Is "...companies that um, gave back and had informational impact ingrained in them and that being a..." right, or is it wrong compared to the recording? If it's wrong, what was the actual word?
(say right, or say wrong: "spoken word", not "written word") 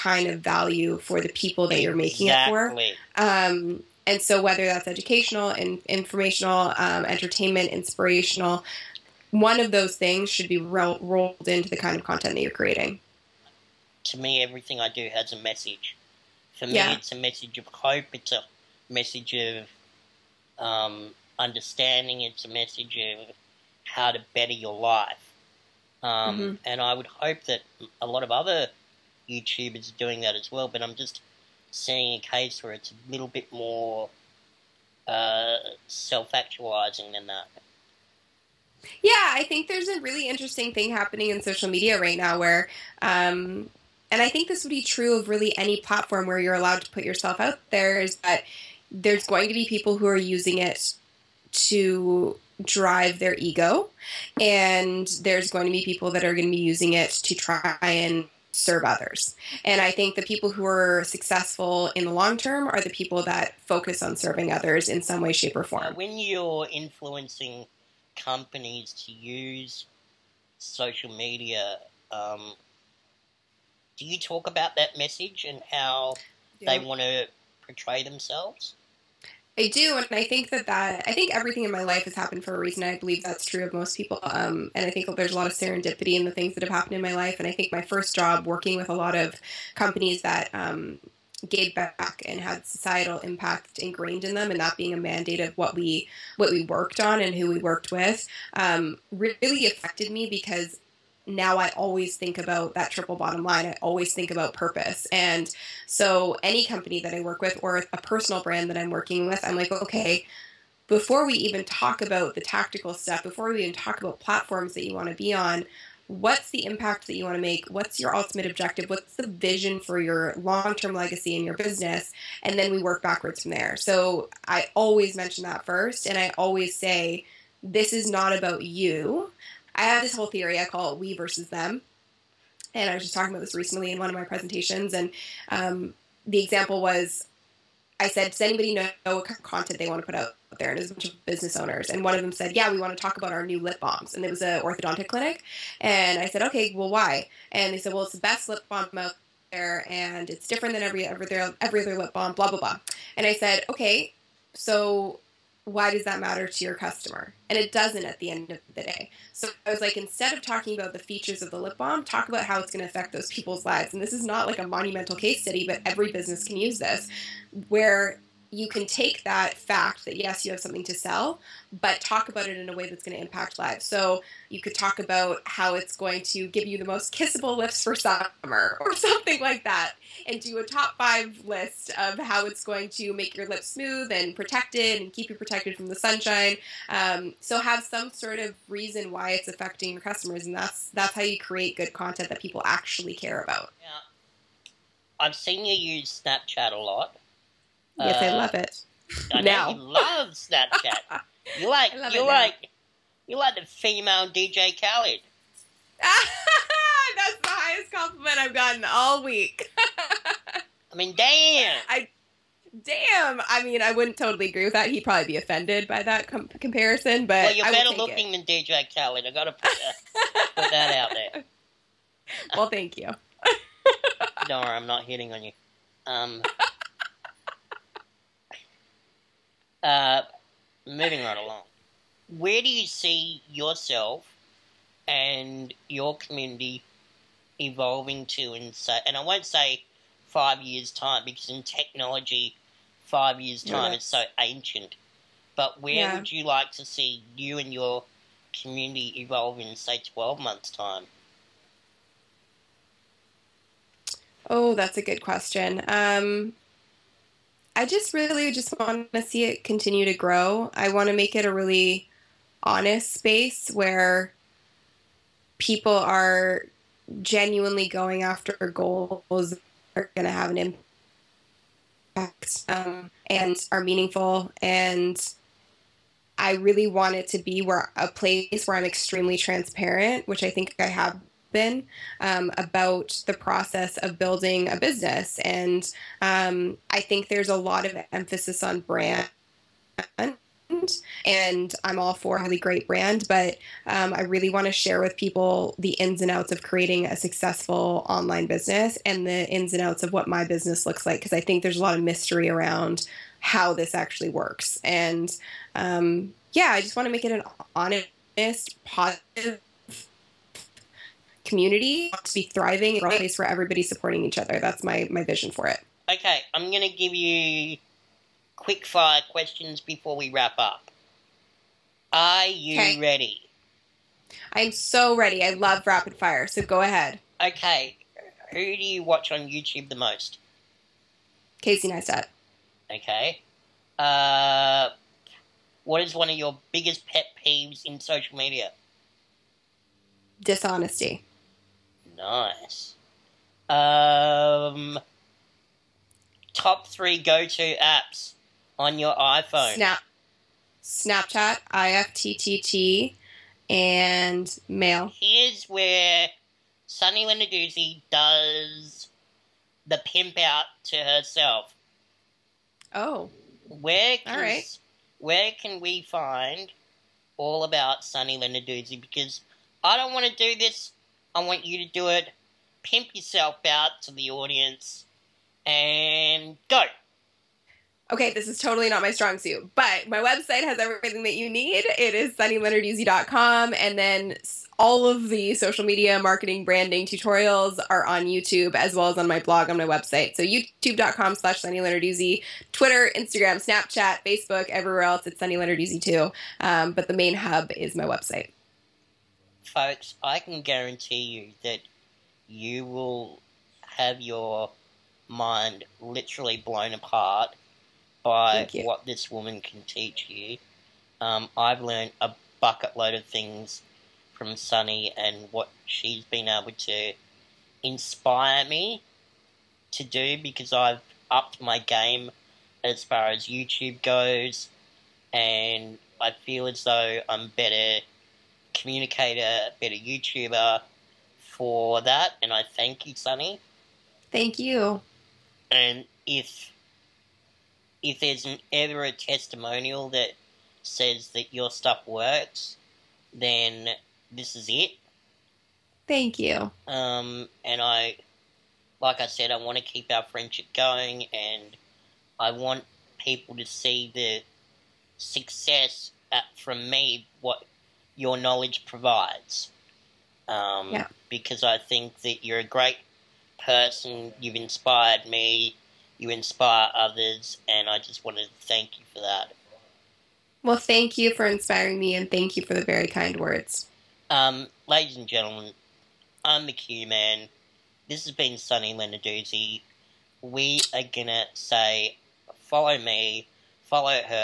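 wrong: "societal", not "informational".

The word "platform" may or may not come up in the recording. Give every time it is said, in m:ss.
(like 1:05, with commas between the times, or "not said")
0:45, 1:54.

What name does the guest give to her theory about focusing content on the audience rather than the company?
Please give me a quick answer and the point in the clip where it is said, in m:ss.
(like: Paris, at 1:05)
We versus them, at 2:10.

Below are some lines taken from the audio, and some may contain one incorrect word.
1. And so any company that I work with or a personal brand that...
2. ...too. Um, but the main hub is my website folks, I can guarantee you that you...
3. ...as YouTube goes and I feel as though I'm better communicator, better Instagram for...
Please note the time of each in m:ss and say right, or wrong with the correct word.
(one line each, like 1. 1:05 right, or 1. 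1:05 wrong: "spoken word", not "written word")
1. 1:45 right
2. 6:36 right
3. 7:03 wrong: "YouTuber", not "Instagram".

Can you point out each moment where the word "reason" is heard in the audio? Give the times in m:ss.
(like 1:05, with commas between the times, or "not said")
1:22, 3:08.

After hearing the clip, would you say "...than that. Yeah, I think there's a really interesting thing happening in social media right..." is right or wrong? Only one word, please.
right.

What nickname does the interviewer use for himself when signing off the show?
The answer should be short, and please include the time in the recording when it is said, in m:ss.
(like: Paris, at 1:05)
The Q Man, at 7:56.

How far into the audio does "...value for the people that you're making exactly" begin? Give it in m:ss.
0:00.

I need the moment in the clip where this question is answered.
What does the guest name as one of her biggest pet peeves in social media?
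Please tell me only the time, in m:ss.
5:40.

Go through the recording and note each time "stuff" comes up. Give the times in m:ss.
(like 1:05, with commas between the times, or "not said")
1:52, 7:21.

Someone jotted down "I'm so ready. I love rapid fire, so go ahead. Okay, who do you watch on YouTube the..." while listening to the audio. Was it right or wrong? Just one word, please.
right.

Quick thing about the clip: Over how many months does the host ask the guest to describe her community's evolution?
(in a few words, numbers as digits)
12.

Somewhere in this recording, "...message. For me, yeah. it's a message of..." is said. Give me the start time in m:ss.
0:15.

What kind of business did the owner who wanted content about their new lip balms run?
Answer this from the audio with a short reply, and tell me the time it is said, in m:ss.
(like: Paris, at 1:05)
Orthodontic clinic, at 2:24.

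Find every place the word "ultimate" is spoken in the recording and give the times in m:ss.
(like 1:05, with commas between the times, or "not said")
1:58.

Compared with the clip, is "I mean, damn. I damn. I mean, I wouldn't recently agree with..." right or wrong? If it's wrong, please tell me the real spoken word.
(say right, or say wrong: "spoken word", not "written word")
wrong: "totally", not "recently".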